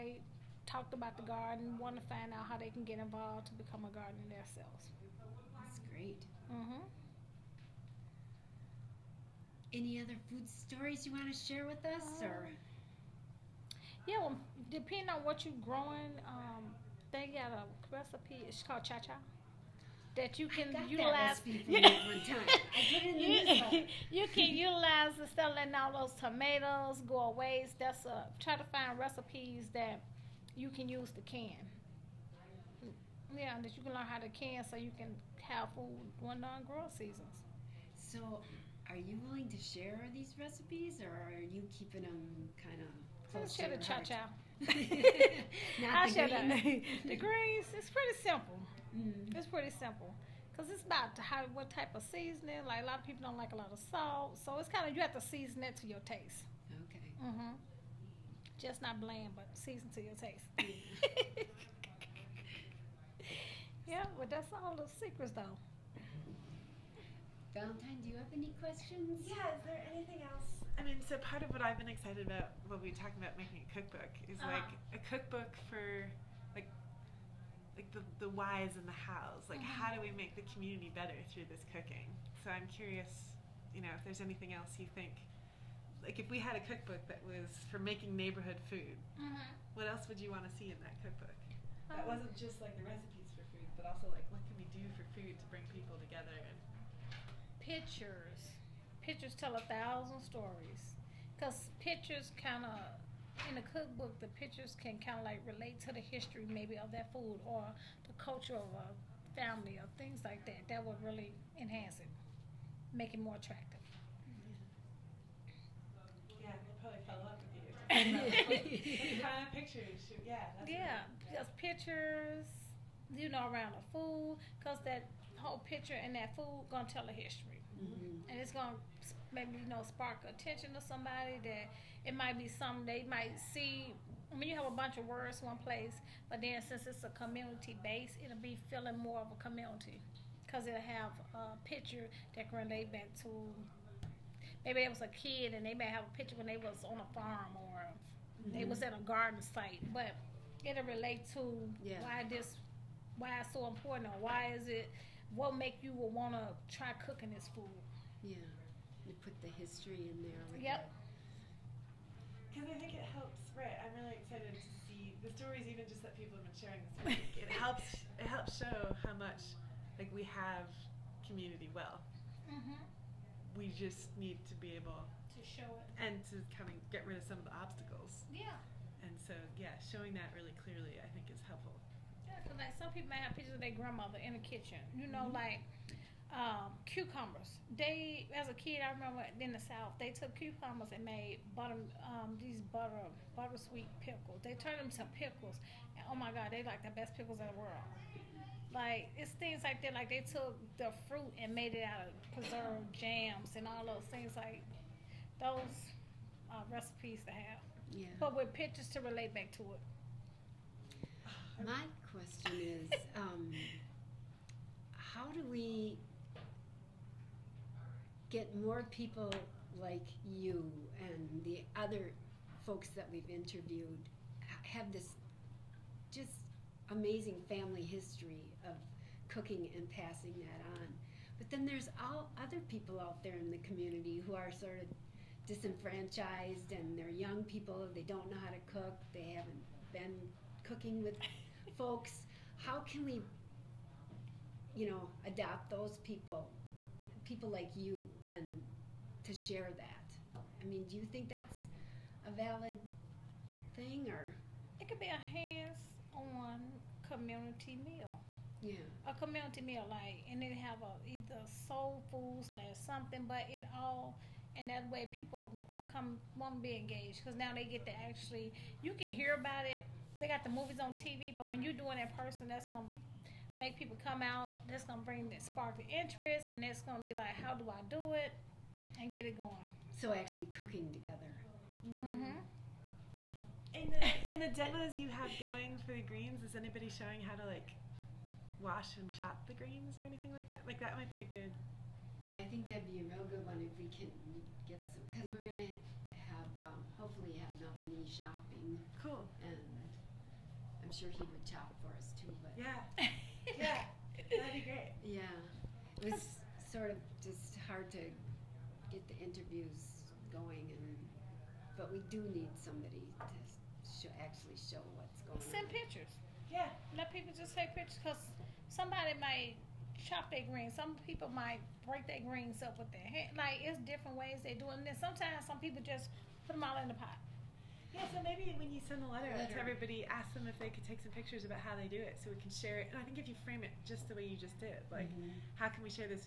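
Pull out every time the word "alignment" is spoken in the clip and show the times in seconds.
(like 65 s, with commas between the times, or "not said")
not said.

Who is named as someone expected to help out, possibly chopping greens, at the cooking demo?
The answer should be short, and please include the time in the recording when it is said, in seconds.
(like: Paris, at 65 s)
Melvin, at 297 s.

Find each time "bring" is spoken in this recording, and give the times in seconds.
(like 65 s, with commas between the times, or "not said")
95 s, 275 s.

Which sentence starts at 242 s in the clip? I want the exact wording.
How can we, you know, adopt those people, people like you, and to share that?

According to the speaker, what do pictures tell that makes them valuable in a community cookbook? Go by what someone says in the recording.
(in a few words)
A thousand stories.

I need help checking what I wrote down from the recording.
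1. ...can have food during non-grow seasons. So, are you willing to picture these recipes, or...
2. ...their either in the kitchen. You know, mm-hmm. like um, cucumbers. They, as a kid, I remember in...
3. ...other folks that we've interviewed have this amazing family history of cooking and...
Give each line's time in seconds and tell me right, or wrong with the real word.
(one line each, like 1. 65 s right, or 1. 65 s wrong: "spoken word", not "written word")
1. 34 s wrong: "share", not "picture"
2. 183 s wrong: "grandmother", not "either"
3. 221 s right.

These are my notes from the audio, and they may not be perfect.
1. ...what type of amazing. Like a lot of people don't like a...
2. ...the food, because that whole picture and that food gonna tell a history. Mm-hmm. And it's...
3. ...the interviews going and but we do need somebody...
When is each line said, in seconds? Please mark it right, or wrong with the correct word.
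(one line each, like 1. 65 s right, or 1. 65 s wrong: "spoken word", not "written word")
1. 51 s wrong: "seasoning", not "amazing"
2. 123 s right
3. 309 s right.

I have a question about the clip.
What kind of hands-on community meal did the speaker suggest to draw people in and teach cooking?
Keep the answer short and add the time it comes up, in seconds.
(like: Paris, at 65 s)
Soul food, at 261 s.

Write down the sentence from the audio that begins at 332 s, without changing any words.
And I think if you frame it just the way you just did, like, mm-hmm.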